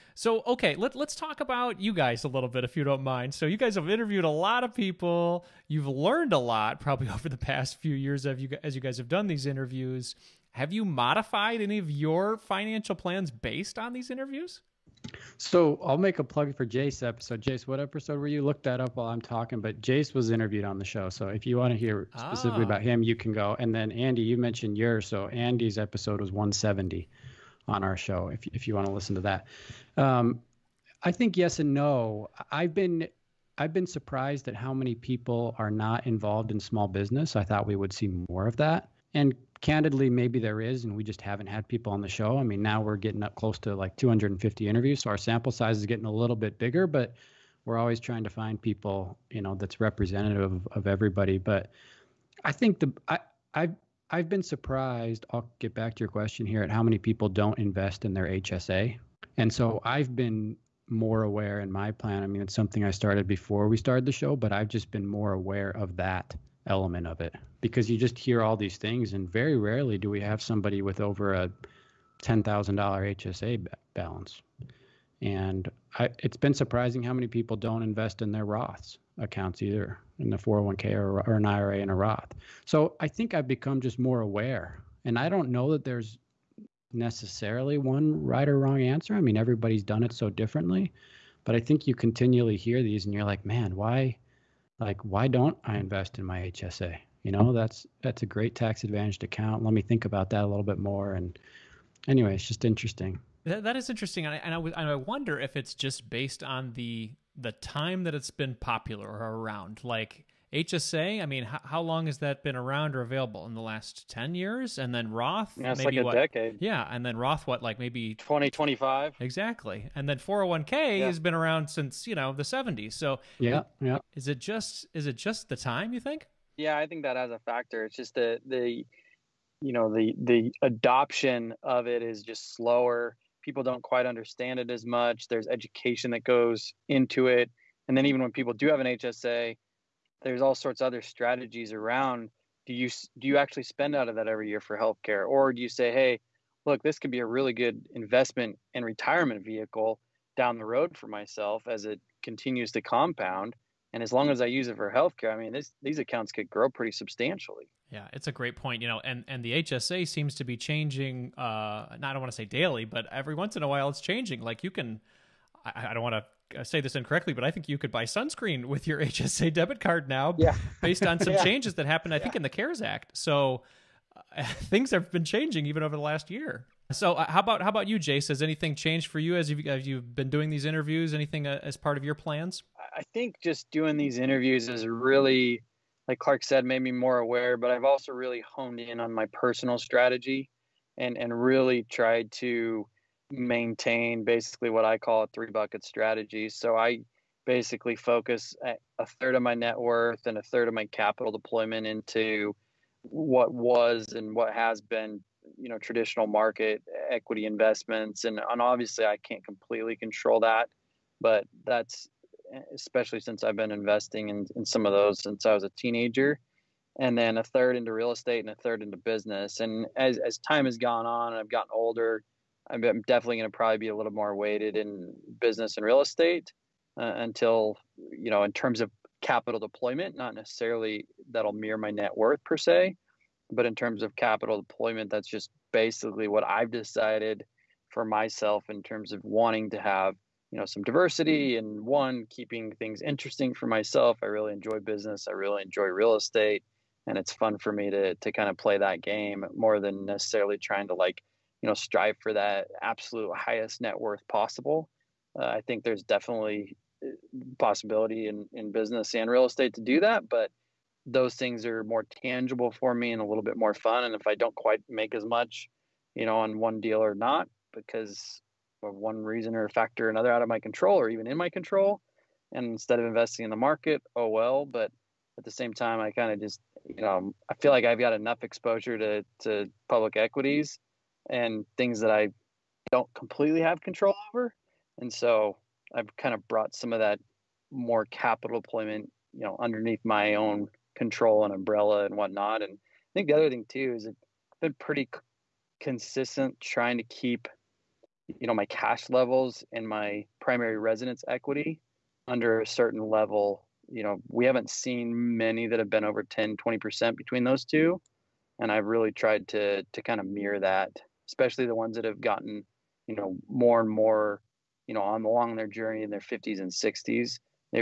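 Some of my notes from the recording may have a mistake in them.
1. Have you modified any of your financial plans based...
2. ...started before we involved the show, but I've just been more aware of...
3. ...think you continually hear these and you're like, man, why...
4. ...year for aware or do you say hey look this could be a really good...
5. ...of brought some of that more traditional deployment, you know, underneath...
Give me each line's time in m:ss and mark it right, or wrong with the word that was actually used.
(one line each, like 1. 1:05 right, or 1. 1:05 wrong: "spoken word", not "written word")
1. 0:10 right
2. 1:02 wrong: "started", not "involved"
3. 1:31 right
4. 2:24 wrong: "healthcare", not "aware"
5. 4:46 wrong: "capital", not "traditional".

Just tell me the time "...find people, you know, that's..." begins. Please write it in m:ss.
0:48.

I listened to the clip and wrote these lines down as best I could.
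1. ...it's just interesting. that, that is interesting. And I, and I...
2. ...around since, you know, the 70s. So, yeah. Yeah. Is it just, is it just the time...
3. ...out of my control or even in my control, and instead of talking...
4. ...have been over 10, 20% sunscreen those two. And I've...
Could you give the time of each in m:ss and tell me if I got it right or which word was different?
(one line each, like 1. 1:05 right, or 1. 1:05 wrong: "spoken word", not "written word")
1. 1:42 right
2. 2:01 right
3. 4:30 wrong: "investing", not "talking"
4. 5:05 wrong: "between", not "sunscreen".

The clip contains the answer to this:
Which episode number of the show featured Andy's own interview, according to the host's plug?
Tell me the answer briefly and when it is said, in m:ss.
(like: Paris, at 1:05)
170, at 0:26.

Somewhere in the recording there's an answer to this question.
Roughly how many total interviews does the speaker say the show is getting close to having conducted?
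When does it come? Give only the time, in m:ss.
0:43.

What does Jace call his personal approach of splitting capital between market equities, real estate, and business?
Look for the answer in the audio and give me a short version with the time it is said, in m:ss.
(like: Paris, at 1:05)
three bucket strategy, at 3:15.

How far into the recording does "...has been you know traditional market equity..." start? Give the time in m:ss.
3:24.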